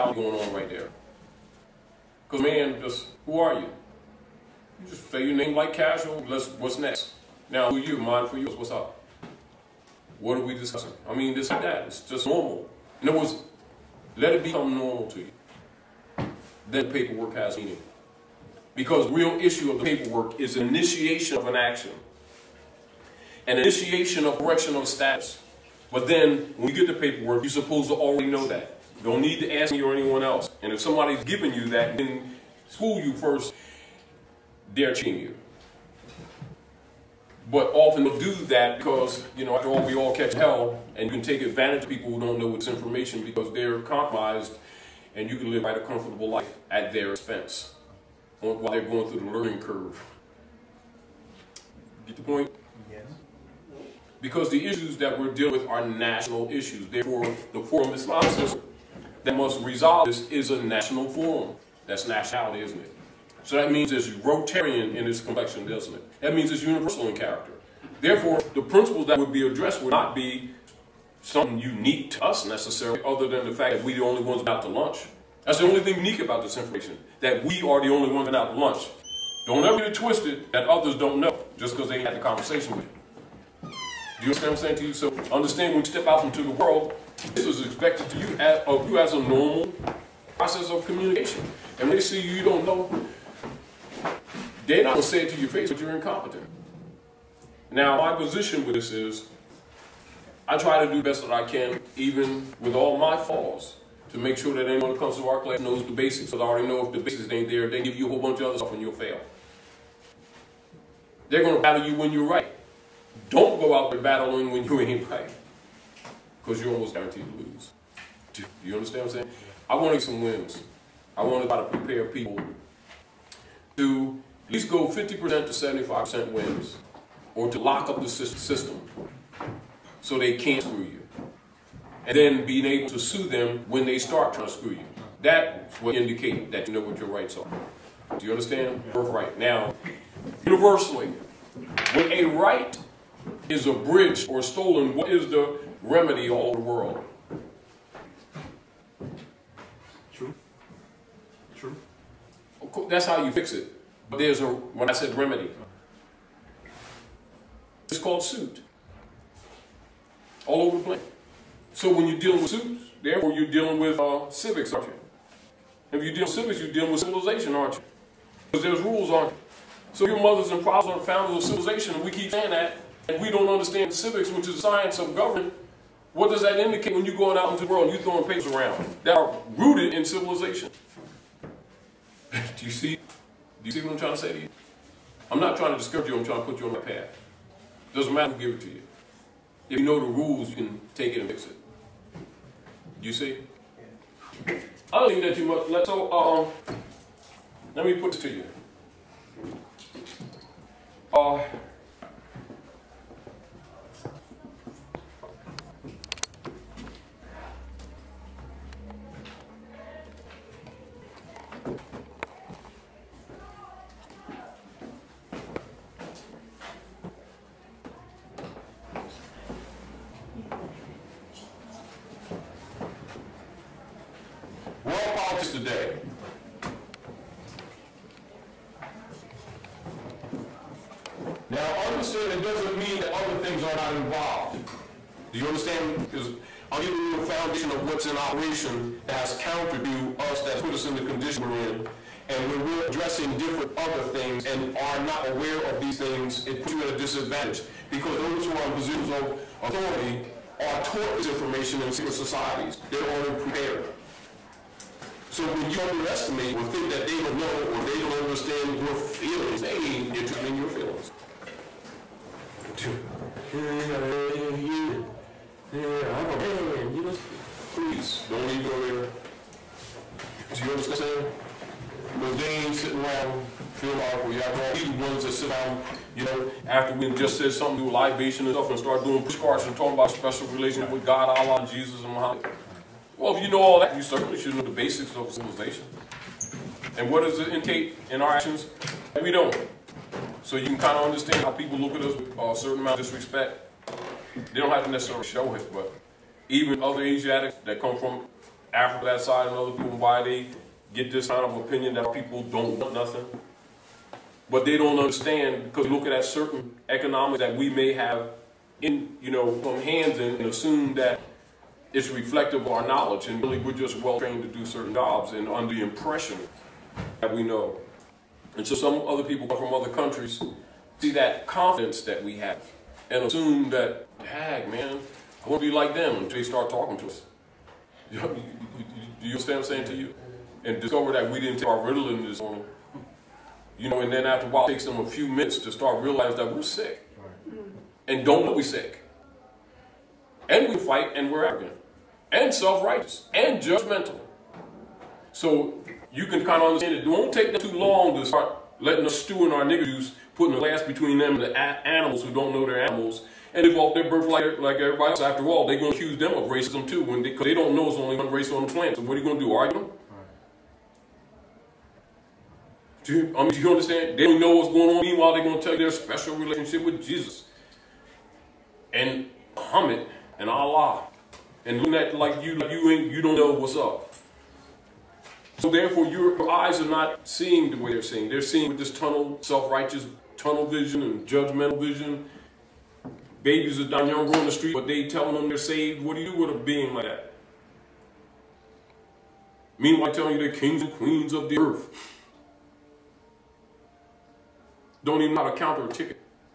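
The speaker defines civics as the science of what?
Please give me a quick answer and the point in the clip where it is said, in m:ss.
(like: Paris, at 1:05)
government, at 2:55.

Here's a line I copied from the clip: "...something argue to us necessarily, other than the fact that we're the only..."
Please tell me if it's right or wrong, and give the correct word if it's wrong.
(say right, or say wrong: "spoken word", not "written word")
wrong: "unique", not "argue".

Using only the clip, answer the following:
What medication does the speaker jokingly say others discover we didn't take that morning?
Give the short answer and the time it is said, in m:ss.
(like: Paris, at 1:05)
Ritalin, at 5:31.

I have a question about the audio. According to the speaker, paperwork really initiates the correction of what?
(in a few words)
status.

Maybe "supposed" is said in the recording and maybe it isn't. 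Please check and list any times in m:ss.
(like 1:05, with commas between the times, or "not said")
0:27.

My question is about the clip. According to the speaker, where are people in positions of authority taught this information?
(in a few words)
secret societies.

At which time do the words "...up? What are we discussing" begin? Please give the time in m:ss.
0:08.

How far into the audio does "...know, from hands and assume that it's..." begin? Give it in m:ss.
5:09.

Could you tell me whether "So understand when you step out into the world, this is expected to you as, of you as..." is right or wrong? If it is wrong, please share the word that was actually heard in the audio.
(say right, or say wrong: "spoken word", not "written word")
right.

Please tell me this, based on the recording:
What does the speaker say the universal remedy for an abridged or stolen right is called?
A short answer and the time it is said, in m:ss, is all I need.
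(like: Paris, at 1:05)
suit, at 2:38.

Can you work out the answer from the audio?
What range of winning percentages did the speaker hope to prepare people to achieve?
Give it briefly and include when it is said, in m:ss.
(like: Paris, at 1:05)
50% to 75%, at 2:04.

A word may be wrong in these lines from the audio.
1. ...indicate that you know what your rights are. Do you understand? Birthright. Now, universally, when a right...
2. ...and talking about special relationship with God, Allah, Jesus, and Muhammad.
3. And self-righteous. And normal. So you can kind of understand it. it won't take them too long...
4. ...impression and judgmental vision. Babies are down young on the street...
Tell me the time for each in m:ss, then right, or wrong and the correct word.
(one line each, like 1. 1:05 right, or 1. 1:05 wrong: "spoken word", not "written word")
1. 2:15 right
2. 4:39 right
3. 5:42 wrong: "judgmental", not "normal"
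4. 6:20 wrong: "vision", not "impression".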